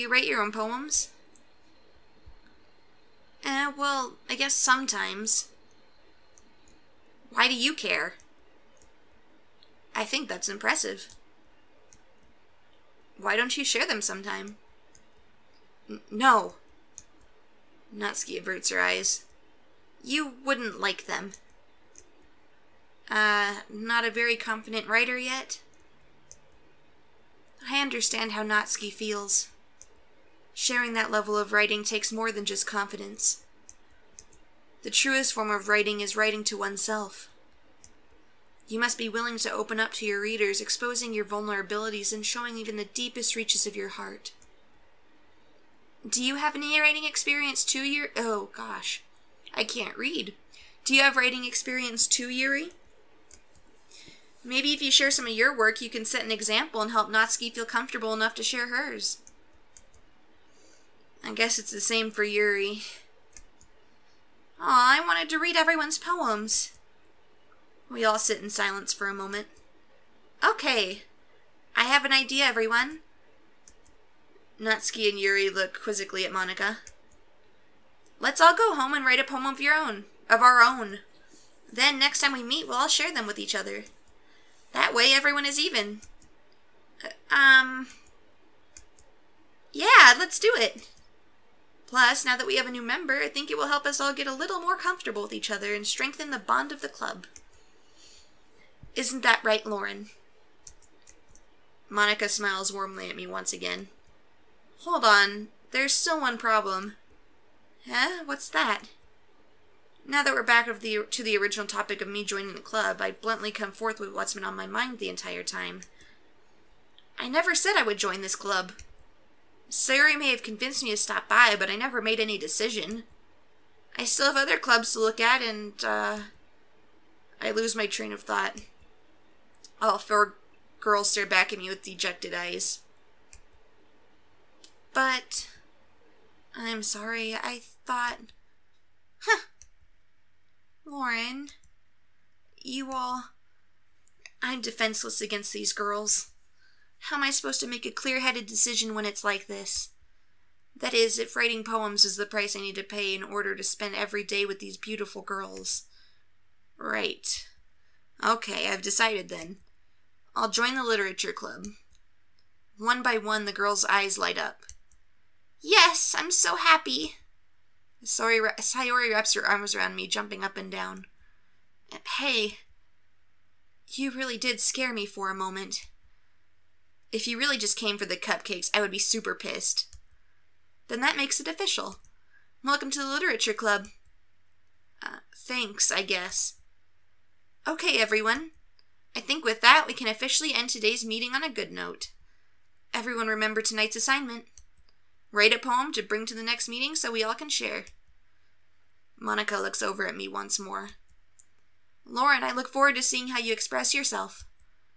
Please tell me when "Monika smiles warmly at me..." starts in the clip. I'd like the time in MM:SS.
01:41.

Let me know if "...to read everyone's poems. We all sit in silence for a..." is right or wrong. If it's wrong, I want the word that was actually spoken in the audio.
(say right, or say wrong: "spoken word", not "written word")
right.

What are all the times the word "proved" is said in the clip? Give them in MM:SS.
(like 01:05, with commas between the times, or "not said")
not said.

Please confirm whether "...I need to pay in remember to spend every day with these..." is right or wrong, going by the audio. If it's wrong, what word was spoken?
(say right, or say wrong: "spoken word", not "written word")
wrong: "order", not "remember".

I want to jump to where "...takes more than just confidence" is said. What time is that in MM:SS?
00:31.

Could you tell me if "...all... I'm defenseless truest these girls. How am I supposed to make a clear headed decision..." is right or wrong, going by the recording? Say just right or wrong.
wrong.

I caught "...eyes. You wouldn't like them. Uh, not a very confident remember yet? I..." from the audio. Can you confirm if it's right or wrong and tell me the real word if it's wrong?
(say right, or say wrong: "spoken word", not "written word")
wrong: "writer", not "remember".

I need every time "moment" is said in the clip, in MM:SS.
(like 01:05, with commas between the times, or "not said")
01:09, 02:55.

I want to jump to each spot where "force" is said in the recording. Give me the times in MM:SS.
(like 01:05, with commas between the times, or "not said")
not said.